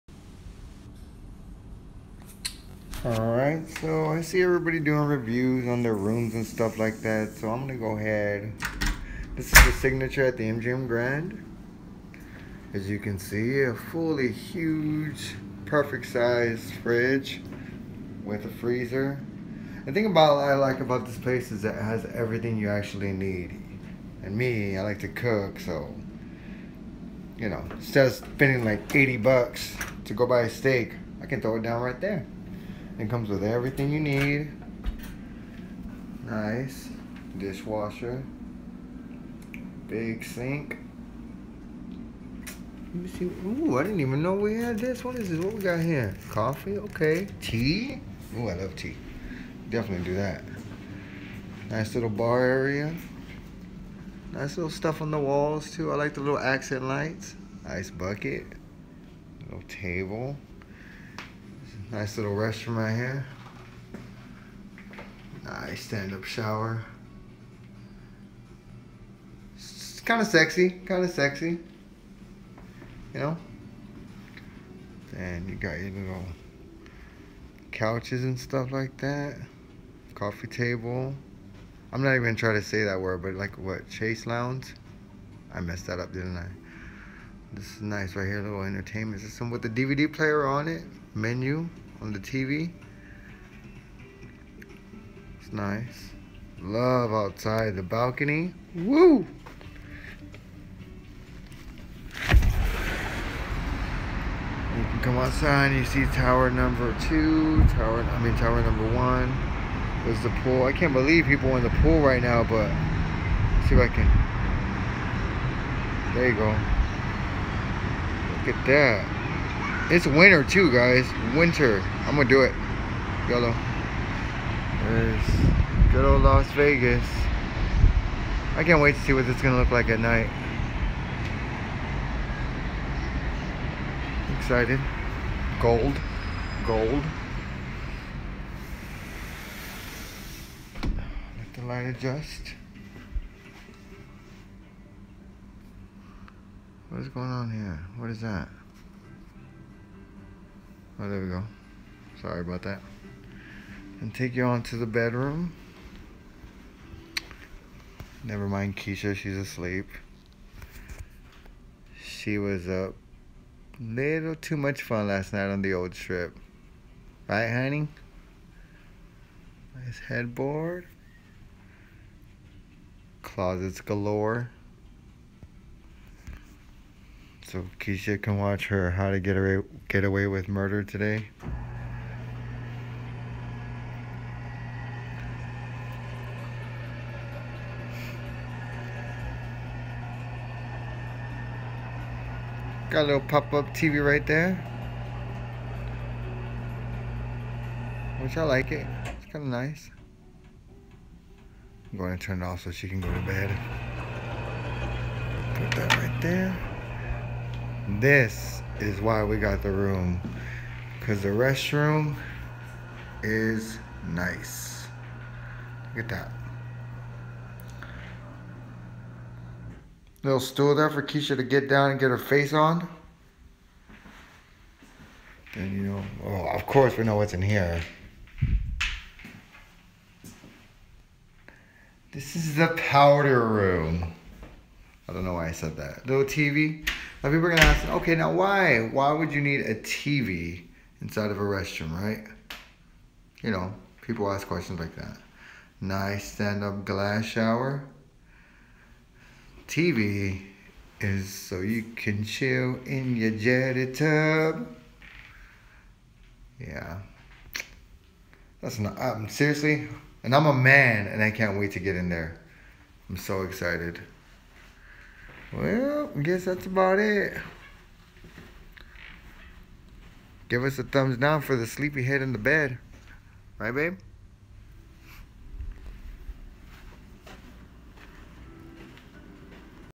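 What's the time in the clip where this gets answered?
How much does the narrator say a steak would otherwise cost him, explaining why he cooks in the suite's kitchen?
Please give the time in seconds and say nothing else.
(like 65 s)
28 s.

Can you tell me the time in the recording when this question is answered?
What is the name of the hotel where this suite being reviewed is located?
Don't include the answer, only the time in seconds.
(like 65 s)
10 s.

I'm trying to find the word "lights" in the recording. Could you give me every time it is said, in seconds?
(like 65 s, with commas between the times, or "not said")
56 s, 141 s.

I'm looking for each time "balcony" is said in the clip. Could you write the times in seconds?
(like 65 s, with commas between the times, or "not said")
97 s.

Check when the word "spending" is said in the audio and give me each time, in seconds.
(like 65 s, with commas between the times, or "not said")
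28 s.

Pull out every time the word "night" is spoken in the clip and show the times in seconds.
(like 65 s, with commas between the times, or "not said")
129 s, 165 s.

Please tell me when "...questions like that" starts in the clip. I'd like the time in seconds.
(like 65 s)
244 s.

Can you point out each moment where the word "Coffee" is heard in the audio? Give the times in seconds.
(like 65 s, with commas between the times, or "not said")
46 s, 80 s.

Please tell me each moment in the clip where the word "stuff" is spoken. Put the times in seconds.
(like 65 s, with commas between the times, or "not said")
6 s, 54 s, 78 s.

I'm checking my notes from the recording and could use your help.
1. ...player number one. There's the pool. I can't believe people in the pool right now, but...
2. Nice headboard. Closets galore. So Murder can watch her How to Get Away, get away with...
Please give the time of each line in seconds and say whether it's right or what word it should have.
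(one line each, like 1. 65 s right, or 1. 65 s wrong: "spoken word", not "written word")
1. 108 s wrong: "tower", not "player"
2. 169 s wrong: "Keisha", not "Murder".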